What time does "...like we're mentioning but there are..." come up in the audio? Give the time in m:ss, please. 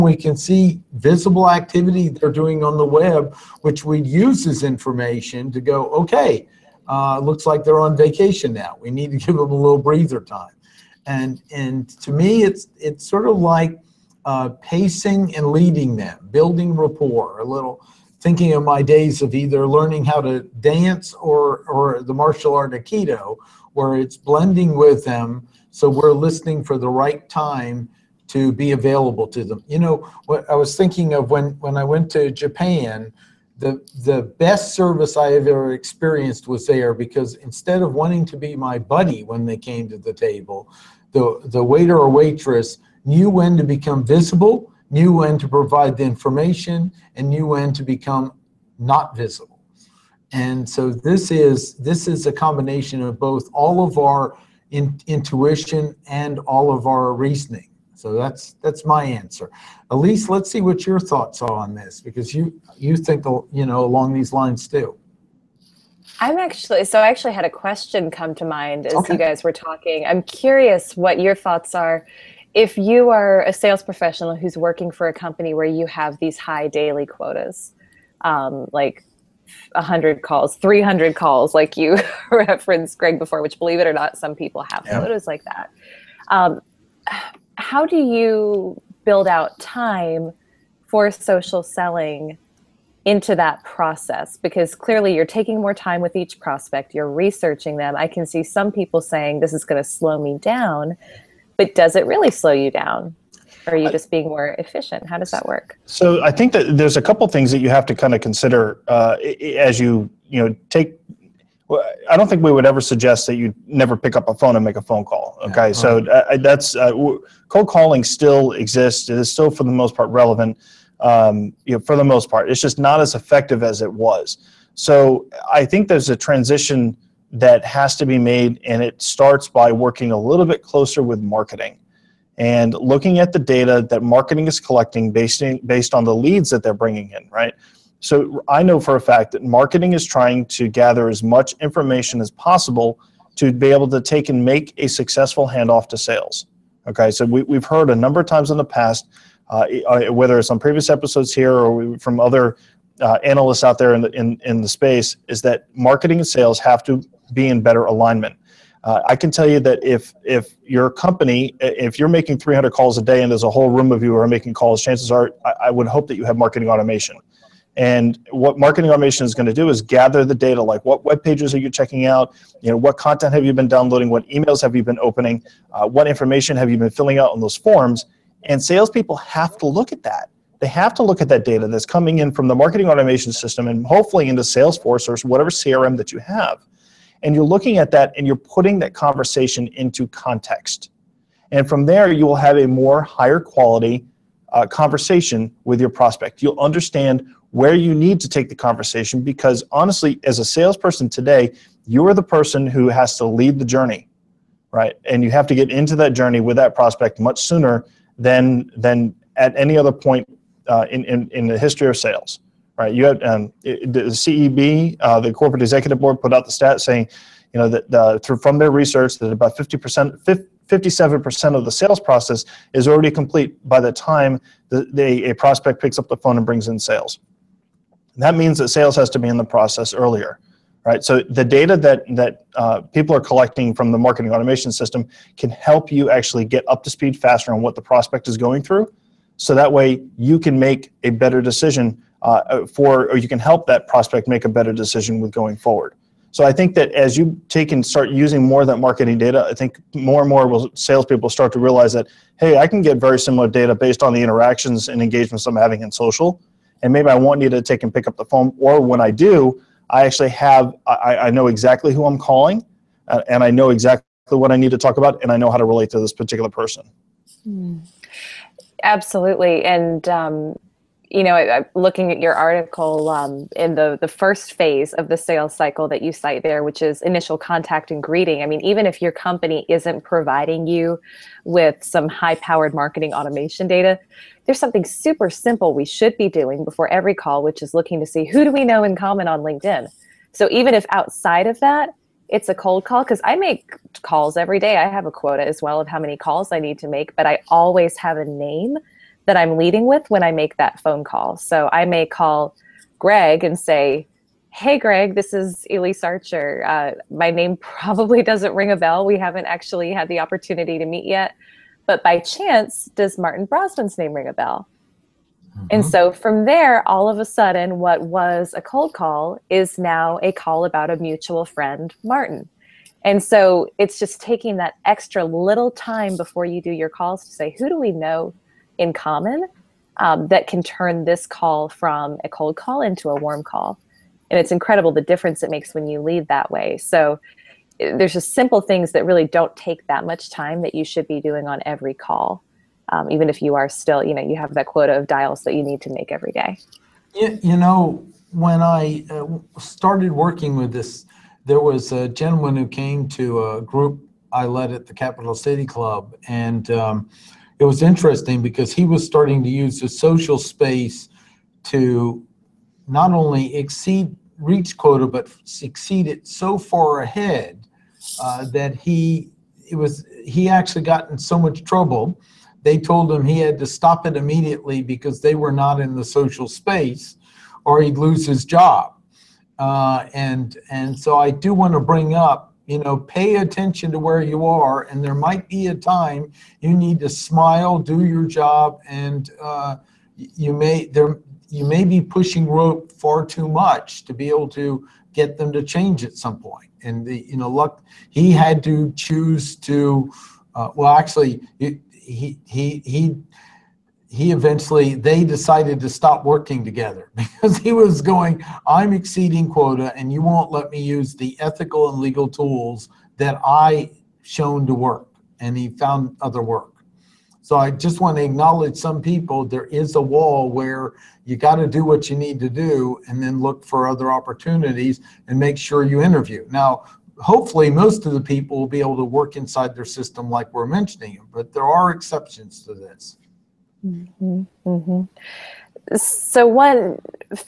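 7:10.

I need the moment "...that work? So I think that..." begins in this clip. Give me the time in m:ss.
1:45.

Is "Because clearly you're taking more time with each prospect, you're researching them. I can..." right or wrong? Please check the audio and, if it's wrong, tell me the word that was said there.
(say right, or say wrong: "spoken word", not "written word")
right.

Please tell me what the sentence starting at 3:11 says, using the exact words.
And from there, you will have a more higher quality uh, conversation with your prospect.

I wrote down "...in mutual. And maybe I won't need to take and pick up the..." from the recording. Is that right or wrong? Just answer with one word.
wrong.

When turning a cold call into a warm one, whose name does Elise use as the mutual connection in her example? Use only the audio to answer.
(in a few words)
Martin Brossman.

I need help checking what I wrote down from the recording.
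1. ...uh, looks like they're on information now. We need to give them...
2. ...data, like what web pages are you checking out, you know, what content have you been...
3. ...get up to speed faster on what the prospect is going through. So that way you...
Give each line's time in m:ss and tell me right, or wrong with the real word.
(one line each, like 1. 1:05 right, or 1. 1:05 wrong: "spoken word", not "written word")
1. 0:06 wrong: "vacation", not "information"
2. 2:50 right
3. 3:56 right.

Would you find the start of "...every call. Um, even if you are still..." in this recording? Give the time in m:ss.
5:41.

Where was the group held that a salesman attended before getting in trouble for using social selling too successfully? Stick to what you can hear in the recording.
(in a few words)
Capital City Club.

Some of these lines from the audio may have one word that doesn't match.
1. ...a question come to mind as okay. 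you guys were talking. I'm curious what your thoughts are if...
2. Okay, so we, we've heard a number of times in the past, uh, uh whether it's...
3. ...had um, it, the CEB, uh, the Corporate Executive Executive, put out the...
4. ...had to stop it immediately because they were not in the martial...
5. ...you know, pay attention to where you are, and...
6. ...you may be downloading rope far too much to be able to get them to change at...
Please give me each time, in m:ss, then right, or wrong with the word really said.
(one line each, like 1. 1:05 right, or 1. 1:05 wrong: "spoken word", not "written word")
1. 1:07 right
2. 2:26 right
3. 3:33 wrong: "Board", not "Executive"
4. 6:13 wrong: "social", not "martial"
5. 6:22 right
6. 6:31 wrong: "pushing", not "downloading".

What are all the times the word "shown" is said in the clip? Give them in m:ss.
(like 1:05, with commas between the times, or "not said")
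6:54.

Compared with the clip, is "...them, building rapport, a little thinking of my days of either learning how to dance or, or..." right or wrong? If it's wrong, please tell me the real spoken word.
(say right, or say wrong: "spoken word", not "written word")
right.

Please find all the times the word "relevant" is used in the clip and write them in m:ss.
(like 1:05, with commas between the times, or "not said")
2:00.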